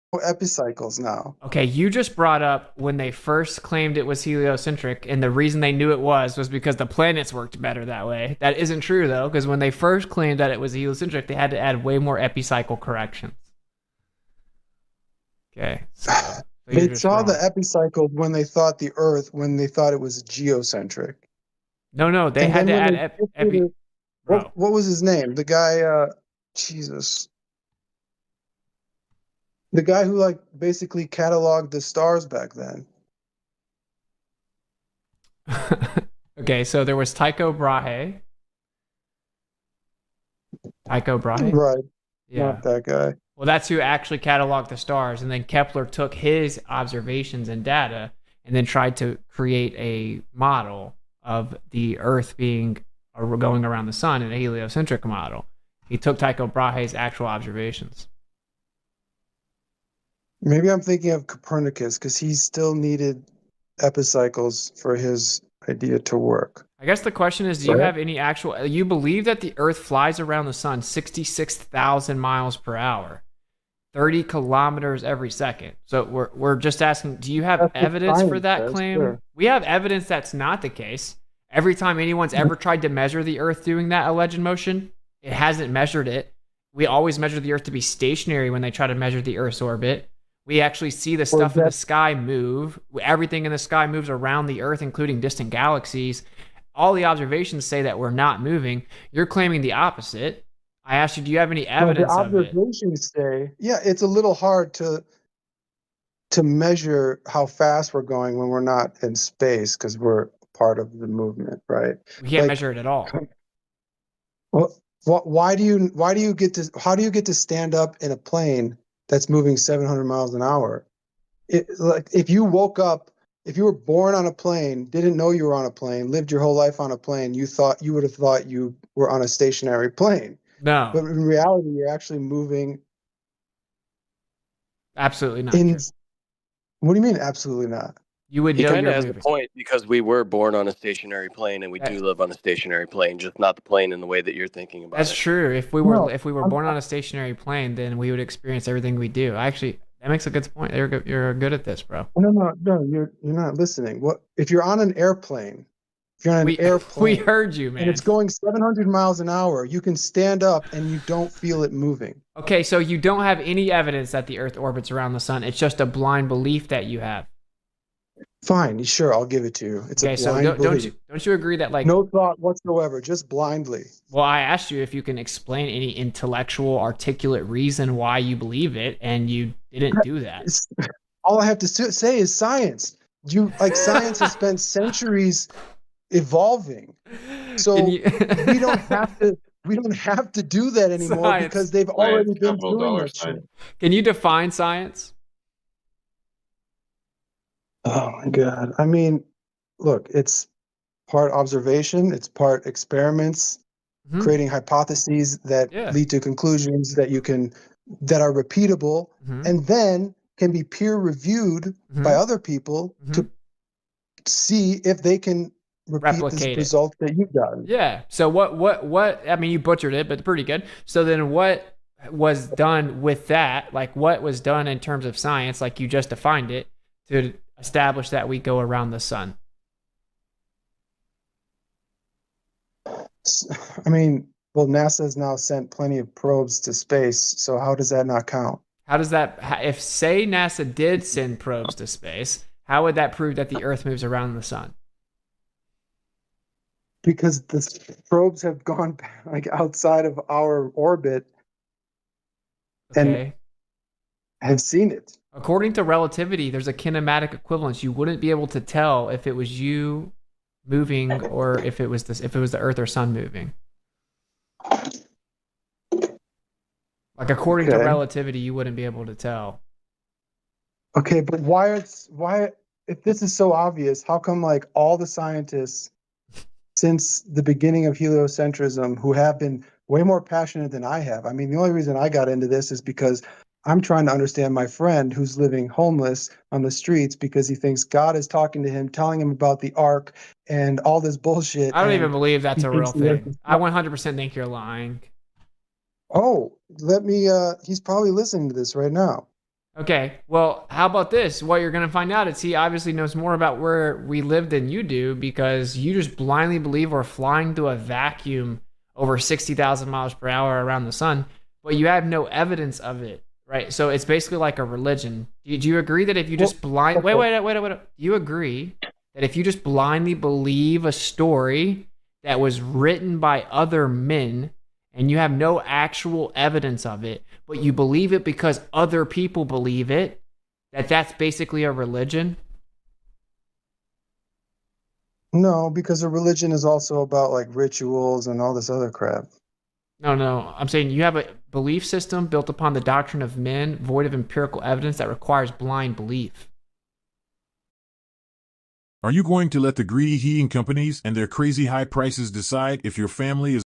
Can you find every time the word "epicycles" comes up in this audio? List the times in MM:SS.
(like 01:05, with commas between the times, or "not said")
00:00, 00:12, 00:17, 01:03.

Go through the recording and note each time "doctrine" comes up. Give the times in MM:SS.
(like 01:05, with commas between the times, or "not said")
05:42.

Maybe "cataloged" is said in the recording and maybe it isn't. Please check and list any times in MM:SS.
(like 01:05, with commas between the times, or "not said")
00:31, 00:44.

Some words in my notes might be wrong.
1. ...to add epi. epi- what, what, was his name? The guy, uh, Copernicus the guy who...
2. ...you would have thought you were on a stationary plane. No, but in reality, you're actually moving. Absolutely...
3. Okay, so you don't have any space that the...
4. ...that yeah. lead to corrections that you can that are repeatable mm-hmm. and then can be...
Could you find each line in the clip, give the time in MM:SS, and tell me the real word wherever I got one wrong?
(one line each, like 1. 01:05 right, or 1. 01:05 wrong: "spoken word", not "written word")
1. 00:22 wrong: "Jesus", not "Copernicus"
2. 02:07 right
3. 02:42 wrong: "evidence", not "space"
4. 03:25 wrong: "conclusions", not "corrections".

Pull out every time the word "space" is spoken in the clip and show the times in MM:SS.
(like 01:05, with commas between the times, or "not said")
01:49, 03:56, 04:01.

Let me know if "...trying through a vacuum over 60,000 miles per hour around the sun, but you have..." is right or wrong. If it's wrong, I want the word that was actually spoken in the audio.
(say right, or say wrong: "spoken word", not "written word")
wrong: "flying", not "trying".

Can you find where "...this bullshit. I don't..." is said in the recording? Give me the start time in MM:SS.
04:50.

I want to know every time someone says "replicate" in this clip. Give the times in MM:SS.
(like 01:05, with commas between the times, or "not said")
03:35.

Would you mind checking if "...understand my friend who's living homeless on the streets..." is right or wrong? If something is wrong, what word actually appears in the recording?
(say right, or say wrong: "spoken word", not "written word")
right.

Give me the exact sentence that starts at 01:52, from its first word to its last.
We can't like, measure it at all.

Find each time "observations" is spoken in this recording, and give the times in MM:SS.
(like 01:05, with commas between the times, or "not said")
00:46, 00:57, 01:37, 01:42, 03:21.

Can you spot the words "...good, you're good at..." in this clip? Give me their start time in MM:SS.
02:30.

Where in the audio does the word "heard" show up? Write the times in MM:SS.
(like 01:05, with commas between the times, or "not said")
02:37.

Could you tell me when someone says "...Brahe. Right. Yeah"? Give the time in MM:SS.
00:41.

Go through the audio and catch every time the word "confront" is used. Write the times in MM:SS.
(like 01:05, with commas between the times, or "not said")
not said.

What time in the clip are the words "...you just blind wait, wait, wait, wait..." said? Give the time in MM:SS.
05:16.